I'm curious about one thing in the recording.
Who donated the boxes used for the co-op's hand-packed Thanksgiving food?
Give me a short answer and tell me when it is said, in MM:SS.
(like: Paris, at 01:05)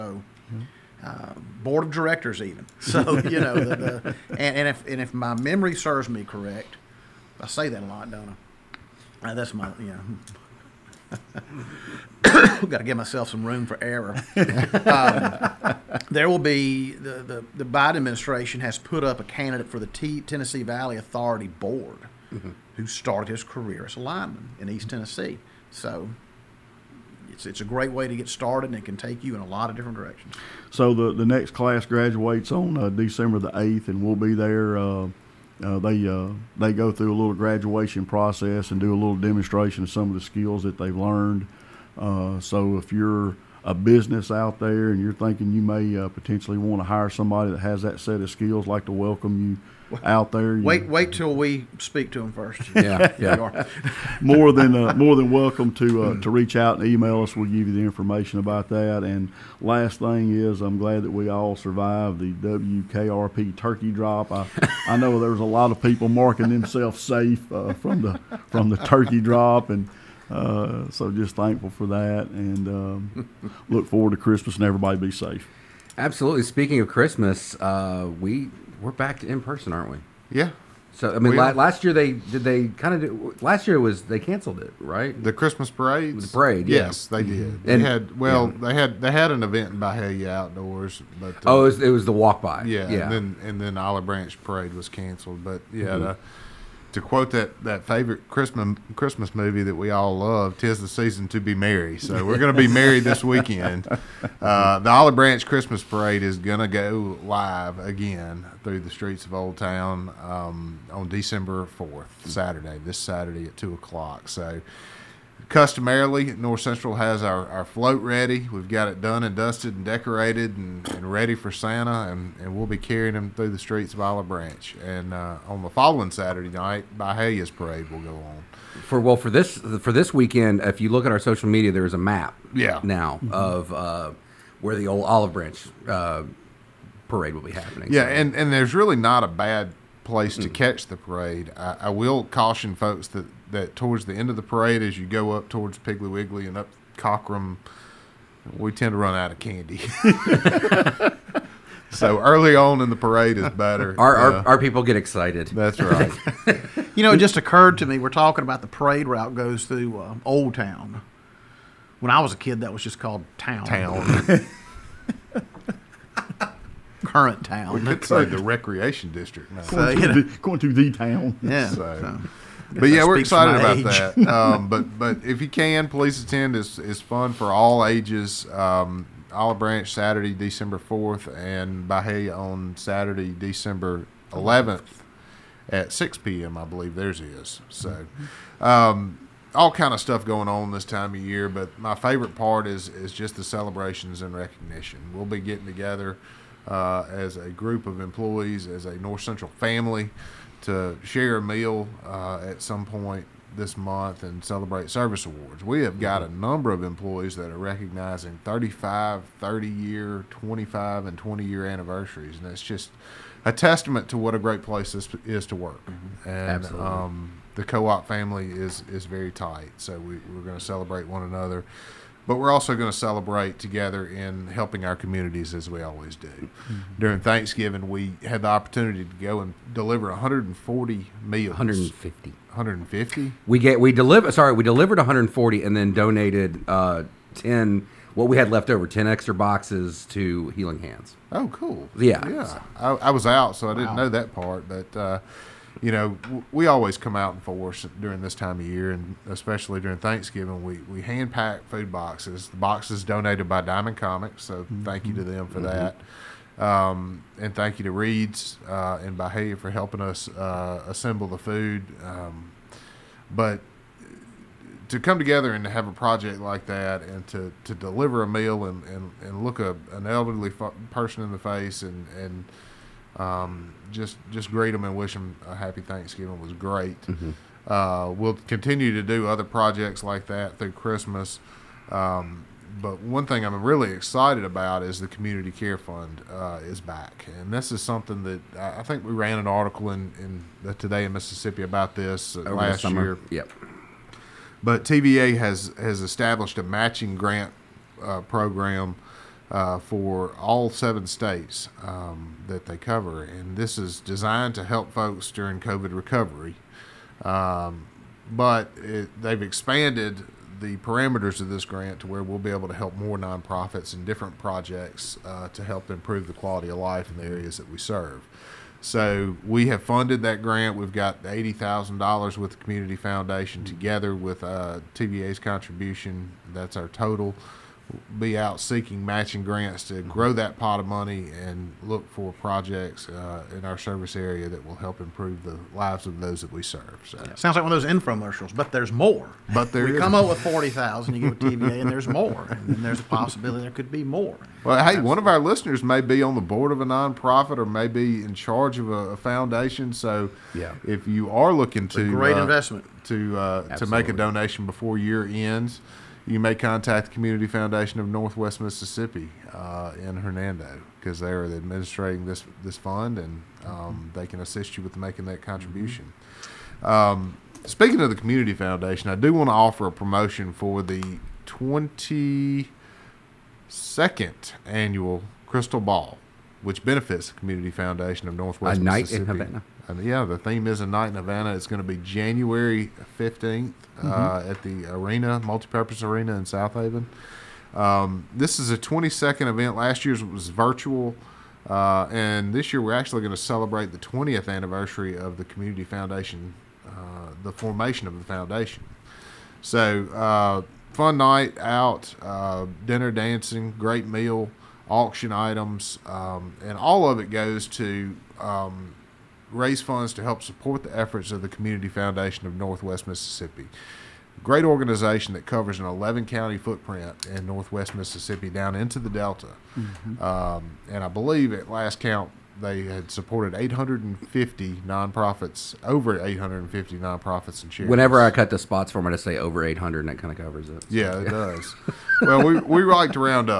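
Diamond Comics, at 04:13.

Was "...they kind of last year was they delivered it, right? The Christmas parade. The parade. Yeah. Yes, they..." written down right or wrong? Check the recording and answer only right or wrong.
wrong.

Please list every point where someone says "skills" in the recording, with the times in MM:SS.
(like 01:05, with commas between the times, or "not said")
00:40, 00:48.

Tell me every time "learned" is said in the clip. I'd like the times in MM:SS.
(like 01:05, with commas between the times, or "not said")
00:40.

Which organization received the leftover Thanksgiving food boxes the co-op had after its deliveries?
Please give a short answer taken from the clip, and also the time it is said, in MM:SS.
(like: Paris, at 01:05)
Healing Hands, at 04:00.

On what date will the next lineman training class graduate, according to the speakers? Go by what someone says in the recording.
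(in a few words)
December 8.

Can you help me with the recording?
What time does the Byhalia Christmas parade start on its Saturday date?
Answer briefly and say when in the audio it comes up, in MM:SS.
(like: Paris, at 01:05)
6 p.m., at 03:05.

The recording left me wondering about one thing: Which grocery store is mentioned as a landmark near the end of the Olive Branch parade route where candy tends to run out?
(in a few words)
Piggly Wiggly.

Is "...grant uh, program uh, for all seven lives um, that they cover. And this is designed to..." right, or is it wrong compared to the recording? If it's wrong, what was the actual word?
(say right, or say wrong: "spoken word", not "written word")
wrong: "states", not "lives".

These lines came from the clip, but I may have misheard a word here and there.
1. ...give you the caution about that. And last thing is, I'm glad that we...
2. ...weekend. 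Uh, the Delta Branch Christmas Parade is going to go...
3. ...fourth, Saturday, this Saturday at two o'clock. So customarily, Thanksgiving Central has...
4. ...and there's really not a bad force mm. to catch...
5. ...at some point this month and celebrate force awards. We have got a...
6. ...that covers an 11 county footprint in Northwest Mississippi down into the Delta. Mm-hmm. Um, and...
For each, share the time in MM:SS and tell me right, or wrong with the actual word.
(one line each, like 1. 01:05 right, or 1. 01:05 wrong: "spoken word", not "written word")
1. 00:57 wrong: "information", not "caution"
2. 01:43 wrong: "Olive", not "Delta"
3. 01:51 wrong: "North", not "Thanksgiving"
4. 02:18 wrong: "place", not "force"
5. 03:22 wrong: "service", not "force"
6. 06:55 right.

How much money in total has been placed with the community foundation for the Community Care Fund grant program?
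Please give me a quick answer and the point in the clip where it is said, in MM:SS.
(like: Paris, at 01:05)
$80,000, at 05:21.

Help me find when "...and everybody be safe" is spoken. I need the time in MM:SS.
01:14.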